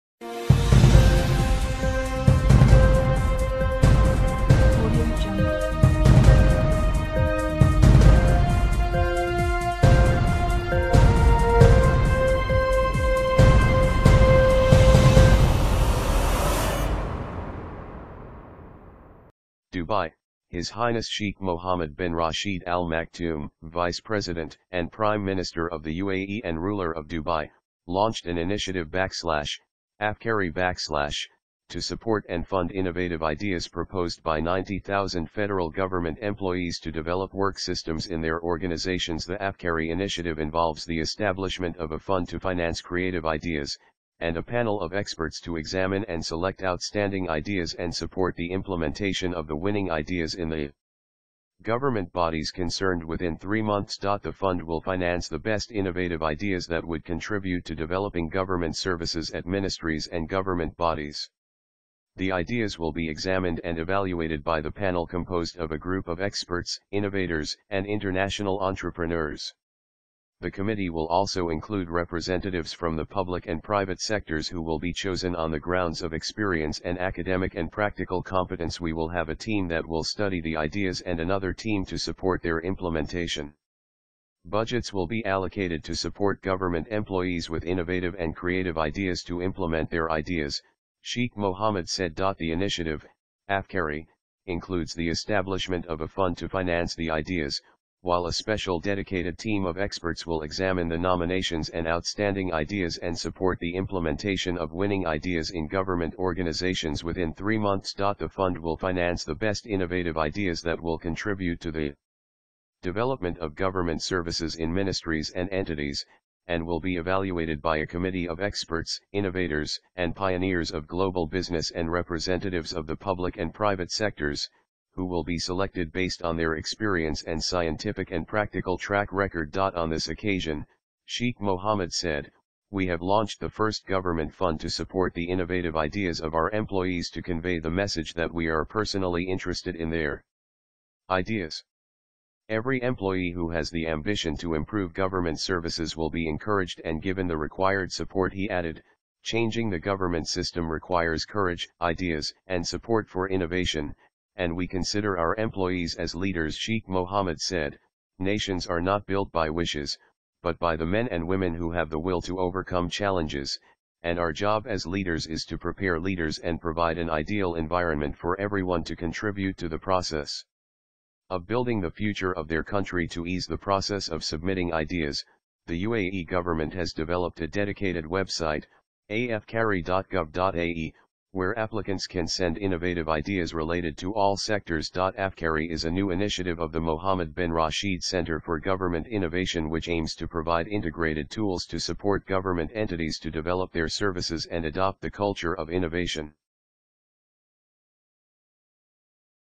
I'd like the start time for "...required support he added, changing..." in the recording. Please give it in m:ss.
2:27.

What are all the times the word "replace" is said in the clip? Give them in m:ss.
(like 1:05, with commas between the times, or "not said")
not said.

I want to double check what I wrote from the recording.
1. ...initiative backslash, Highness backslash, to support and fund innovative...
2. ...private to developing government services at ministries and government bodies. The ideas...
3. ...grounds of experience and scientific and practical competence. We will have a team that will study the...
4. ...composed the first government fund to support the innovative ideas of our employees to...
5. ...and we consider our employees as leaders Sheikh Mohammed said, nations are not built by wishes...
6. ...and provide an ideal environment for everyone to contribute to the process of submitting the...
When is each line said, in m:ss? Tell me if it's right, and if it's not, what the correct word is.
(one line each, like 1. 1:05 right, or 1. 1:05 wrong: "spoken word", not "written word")
1. 0:28 wrong: "Afkari", not "Highness"
2. 0:57 wrong: "contribute", not "private"
3. 1:15 wrong: "academic", not "scientific"
4. 2:13 wrong: "launched", not "composed"
5. 2:34 right
6. 2:46 wrong: "building", not "submitting".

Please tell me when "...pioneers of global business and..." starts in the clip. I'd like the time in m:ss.
2:00.